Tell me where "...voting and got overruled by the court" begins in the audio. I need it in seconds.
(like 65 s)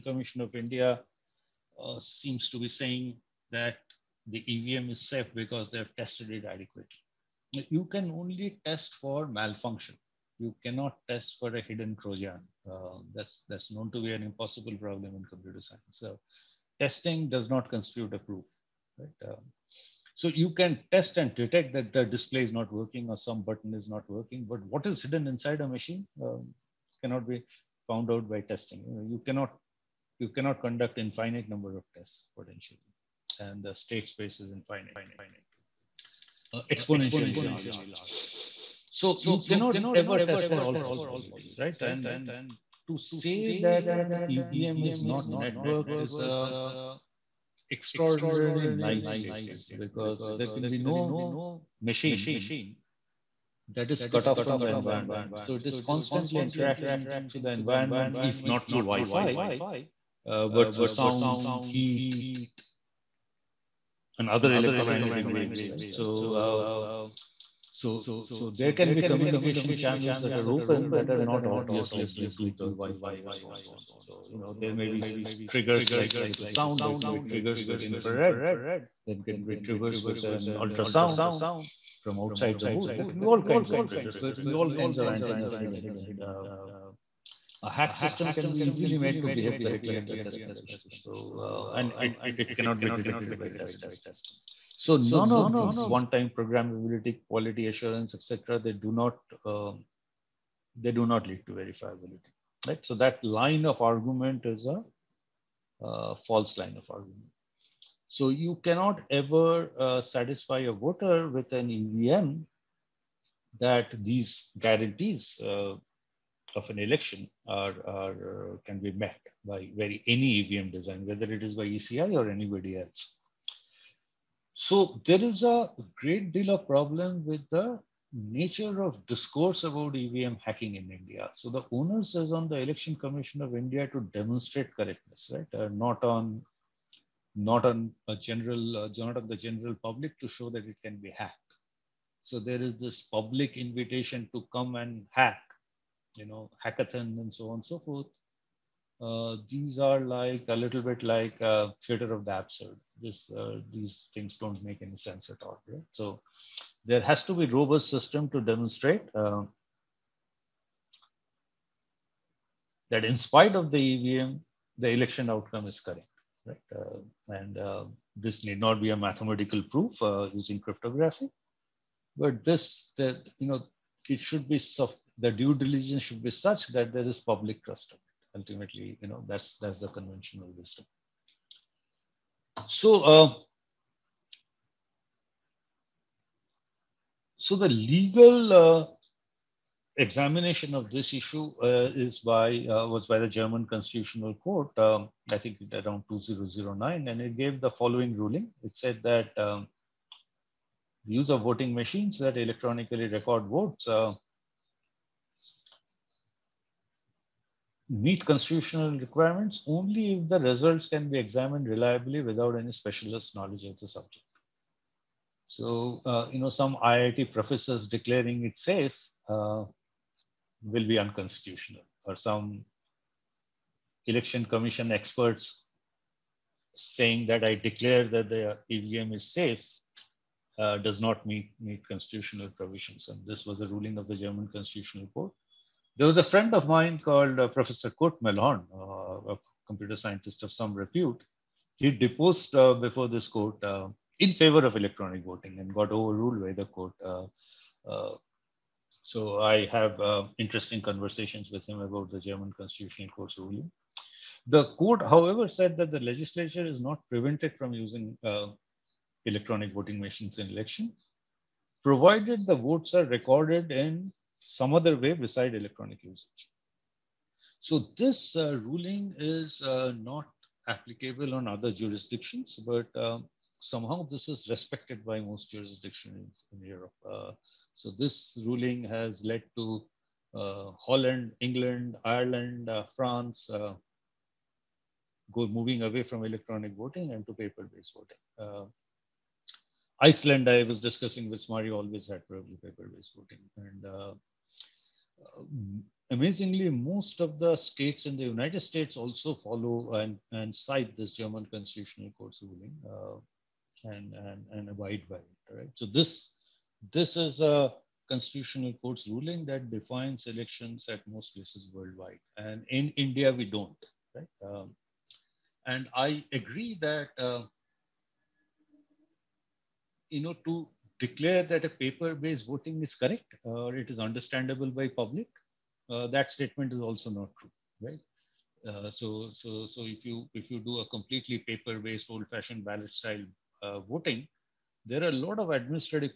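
245 s.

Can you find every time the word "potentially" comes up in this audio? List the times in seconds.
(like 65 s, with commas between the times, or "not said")
32 s.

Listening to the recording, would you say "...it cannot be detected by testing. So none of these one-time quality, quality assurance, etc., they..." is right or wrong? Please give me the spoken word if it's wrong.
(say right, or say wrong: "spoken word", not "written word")
wrong: "programmability", not "quality".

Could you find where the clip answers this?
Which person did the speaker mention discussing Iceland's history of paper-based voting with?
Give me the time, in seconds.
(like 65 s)
291 s.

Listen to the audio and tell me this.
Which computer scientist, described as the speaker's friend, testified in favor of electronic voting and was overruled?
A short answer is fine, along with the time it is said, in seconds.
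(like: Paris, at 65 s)
Kurt Mehlhorn, at 237 s.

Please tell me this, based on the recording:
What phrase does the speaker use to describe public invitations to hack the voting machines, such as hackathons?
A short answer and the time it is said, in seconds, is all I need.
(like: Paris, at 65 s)
theater of the absurd, at 151 s.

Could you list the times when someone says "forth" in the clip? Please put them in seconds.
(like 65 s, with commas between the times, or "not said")
73 s, 147 s.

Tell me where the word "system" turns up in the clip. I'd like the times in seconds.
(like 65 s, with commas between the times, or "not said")
87 s, 157 s.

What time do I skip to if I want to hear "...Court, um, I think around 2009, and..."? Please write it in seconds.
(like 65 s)
194 s.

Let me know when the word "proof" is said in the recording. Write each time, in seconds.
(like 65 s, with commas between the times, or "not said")
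18 s, 169 s.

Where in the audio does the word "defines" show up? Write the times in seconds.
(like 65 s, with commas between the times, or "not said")
309 s.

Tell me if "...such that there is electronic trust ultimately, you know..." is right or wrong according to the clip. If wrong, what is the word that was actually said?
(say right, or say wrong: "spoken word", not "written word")
wrong: "public", not "electronic".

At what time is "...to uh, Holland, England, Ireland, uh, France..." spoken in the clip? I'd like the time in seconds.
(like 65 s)
279 s.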